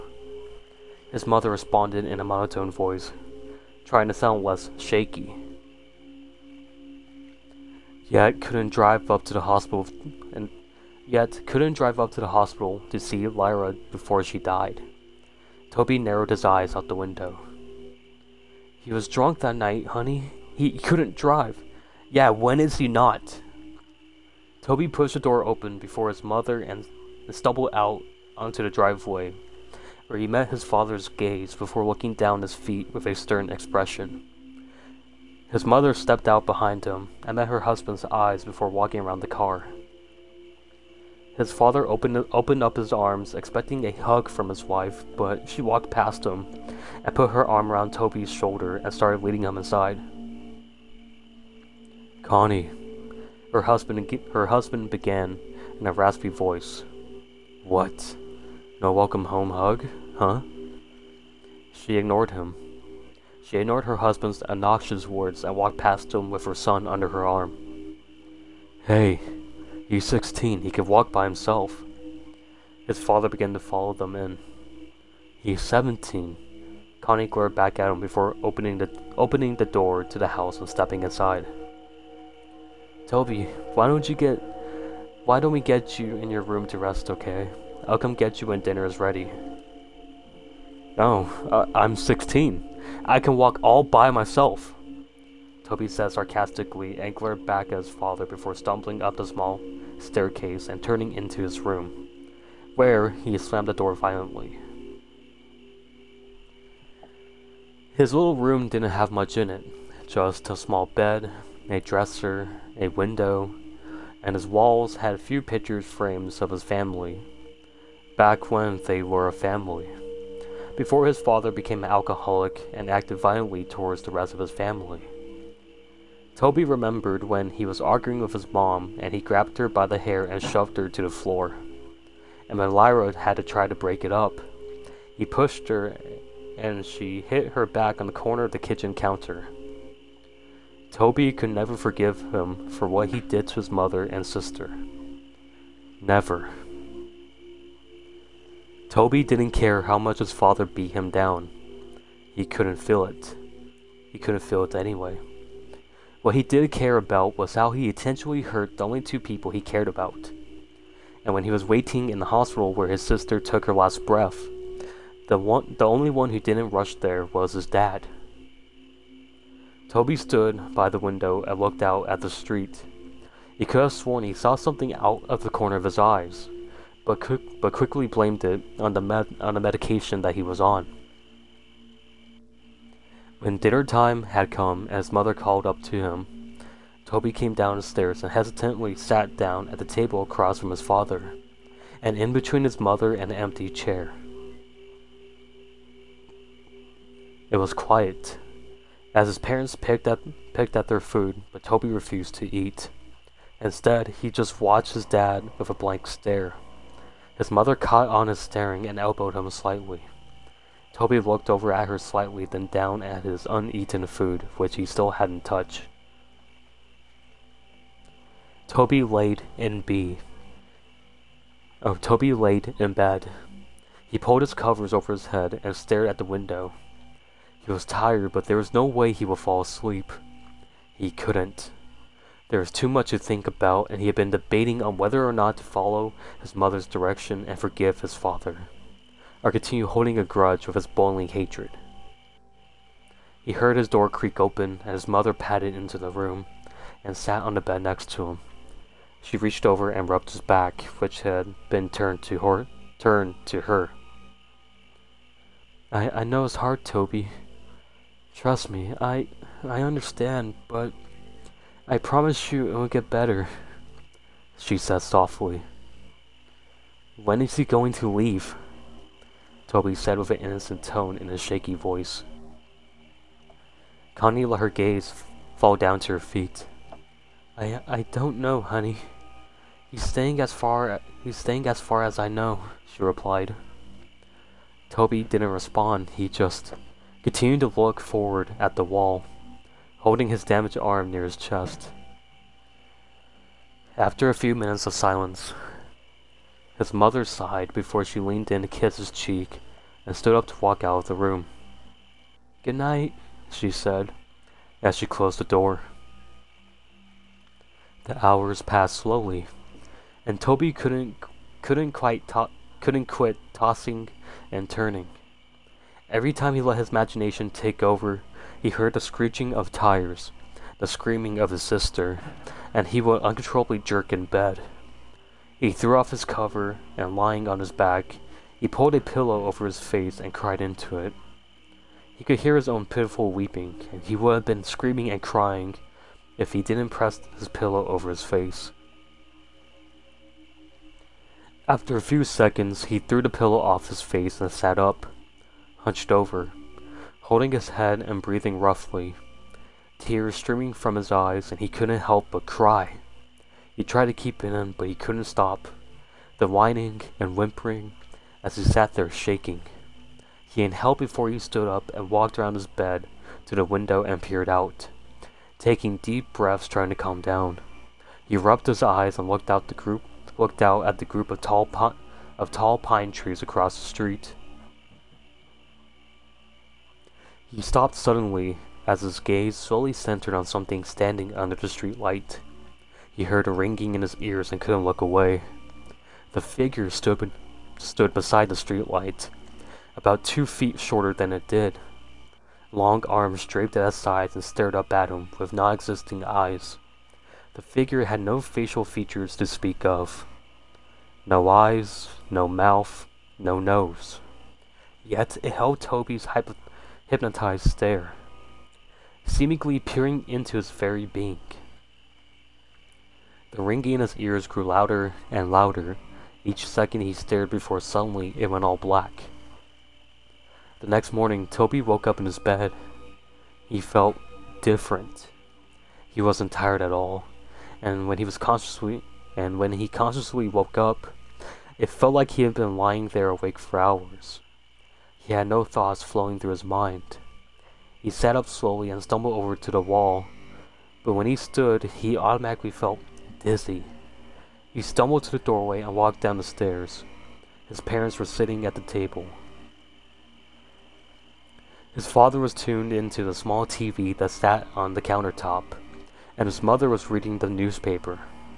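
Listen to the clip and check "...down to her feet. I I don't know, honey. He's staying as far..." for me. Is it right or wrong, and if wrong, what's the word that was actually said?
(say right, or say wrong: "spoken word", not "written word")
right.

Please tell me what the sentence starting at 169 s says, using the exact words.
Toby stood by the window and looked out at the street.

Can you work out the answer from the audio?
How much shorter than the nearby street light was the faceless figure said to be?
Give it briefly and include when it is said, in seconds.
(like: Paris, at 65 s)
2 feet, at 390 s.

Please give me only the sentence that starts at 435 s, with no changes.
He had no thoughts flowing through his mind.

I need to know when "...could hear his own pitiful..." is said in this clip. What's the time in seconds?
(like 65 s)
332 s.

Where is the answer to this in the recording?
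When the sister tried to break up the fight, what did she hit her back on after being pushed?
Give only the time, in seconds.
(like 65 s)
138 s.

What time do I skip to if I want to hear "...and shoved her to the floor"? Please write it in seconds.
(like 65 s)
130 s.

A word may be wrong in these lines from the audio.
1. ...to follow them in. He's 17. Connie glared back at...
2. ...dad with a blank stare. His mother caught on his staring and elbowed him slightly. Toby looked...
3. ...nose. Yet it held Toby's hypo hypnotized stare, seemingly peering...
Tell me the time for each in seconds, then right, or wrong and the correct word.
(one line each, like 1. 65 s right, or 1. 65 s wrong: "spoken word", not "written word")
1. 73 s right
2. 205 s right
3. 403 s right.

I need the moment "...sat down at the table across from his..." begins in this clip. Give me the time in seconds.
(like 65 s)
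188 s.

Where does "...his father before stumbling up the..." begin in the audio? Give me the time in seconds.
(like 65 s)
97 s.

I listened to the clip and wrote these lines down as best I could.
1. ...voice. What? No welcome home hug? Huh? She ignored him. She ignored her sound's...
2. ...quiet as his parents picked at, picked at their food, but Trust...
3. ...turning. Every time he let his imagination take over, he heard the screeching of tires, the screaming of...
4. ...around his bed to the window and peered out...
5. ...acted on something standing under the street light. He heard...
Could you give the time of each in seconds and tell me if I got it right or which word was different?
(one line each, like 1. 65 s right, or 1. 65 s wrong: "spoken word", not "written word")
1. 56 s wrong: "husband", not "sound"
2. 197 s wrong: "Toby", not "Trust"
3. 314 s right
4. 362 s right
5. 379 s wrong: "centered", not "acted".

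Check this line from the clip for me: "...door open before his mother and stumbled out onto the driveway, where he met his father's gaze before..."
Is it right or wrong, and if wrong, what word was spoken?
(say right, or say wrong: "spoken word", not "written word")
right.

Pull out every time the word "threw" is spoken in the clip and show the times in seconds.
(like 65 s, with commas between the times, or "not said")
325 s, 342 s.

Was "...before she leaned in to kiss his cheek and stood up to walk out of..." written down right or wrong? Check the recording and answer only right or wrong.
right.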